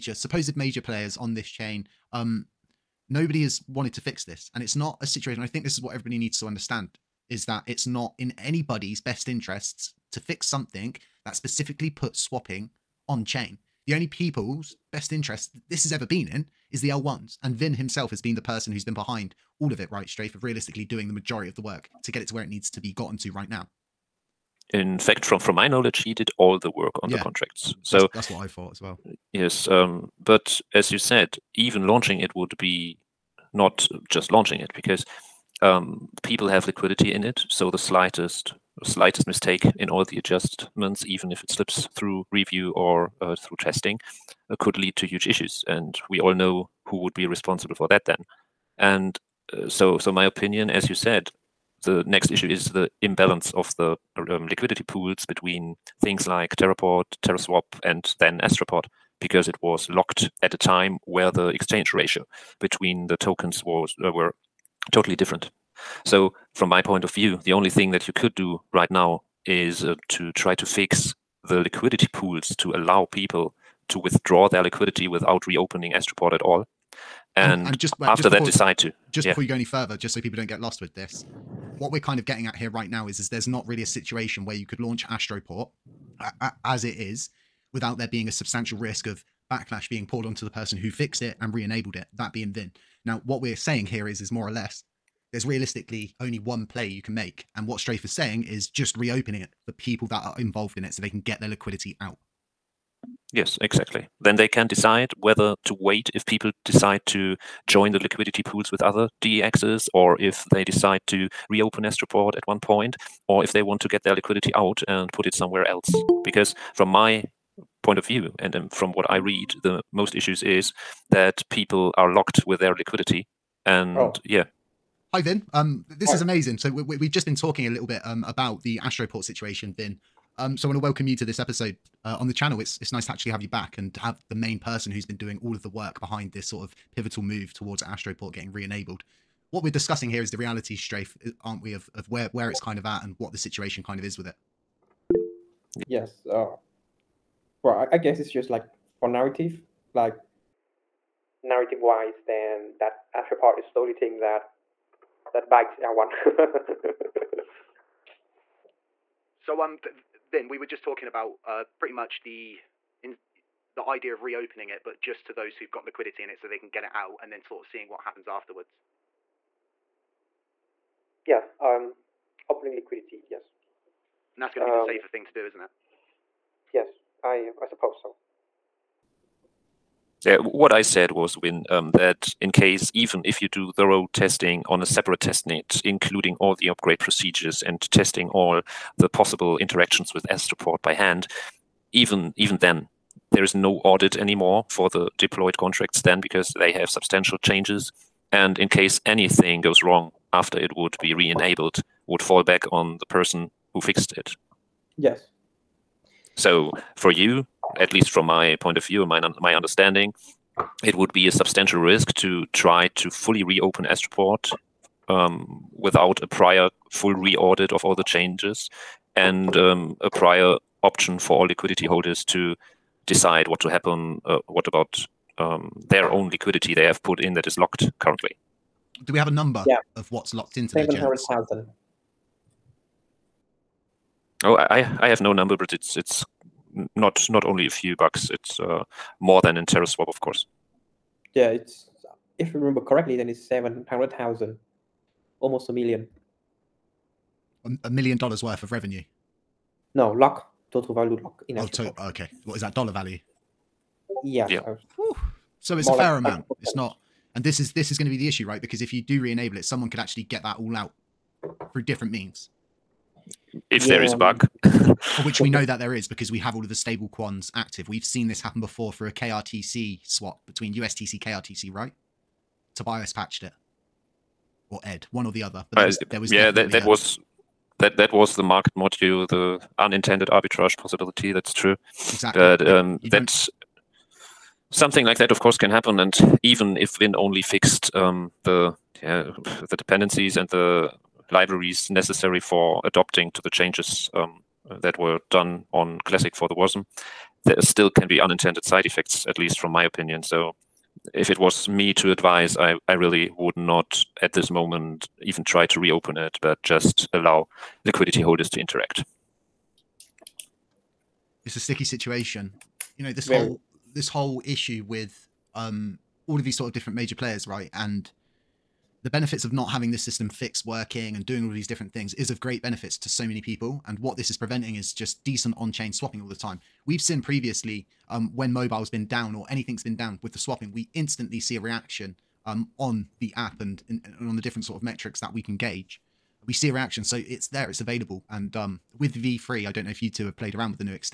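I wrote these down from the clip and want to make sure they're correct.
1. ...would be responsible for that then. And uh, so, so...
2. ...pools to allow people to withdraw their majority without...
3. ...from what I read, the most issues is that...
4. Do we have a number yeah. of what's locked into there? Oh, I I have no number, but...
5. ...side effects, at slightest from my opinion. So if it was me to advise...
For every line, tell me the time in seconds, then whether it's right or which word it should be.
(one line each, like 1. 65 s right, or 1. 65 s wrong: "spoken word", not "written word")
1. 47 s right
2. 72 s wrong: "liquidity", not "majority"
3. 118 s right
4. 229 s right
5. 298 s wrong: "least", not "slightest".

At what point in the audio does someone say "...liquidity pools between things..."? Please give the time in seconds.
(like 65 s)
54 s.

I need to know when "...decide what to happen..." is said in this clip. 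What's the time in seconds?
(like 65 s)
223 s.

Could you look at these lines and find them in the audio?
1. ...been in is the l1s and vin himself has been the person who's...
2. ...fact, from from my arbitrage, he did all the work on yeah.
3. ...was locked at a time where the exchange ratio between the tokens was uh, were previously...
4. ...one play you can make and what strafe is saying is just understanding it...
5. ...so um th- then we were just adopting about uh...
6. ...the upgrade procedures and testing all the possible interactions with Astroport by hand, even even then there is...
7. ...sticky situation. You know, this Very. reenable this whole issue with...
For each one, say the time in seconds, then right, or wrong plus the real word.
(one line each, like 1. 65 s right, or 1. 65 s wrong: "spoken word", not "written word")
1. 16 s right
2. 24 s wrong: "knowledge", not "arbitrage"
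3. 59 s wrong: "totally", not "previously"
4. 96 s wrong: "reopening", not "understanding"
5. 159 s wrong: "talking", not "adopting"
6. 186 s right
7. 311 s wrong: "whole", not "reenable".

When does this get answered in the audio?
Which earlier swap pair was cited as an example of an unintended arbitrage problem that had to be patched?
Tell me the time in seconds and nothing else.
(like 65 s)
270 s.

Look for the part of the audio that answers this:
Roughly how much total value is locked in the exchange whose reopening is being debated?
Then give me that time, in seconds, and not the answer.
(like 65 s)
243 s.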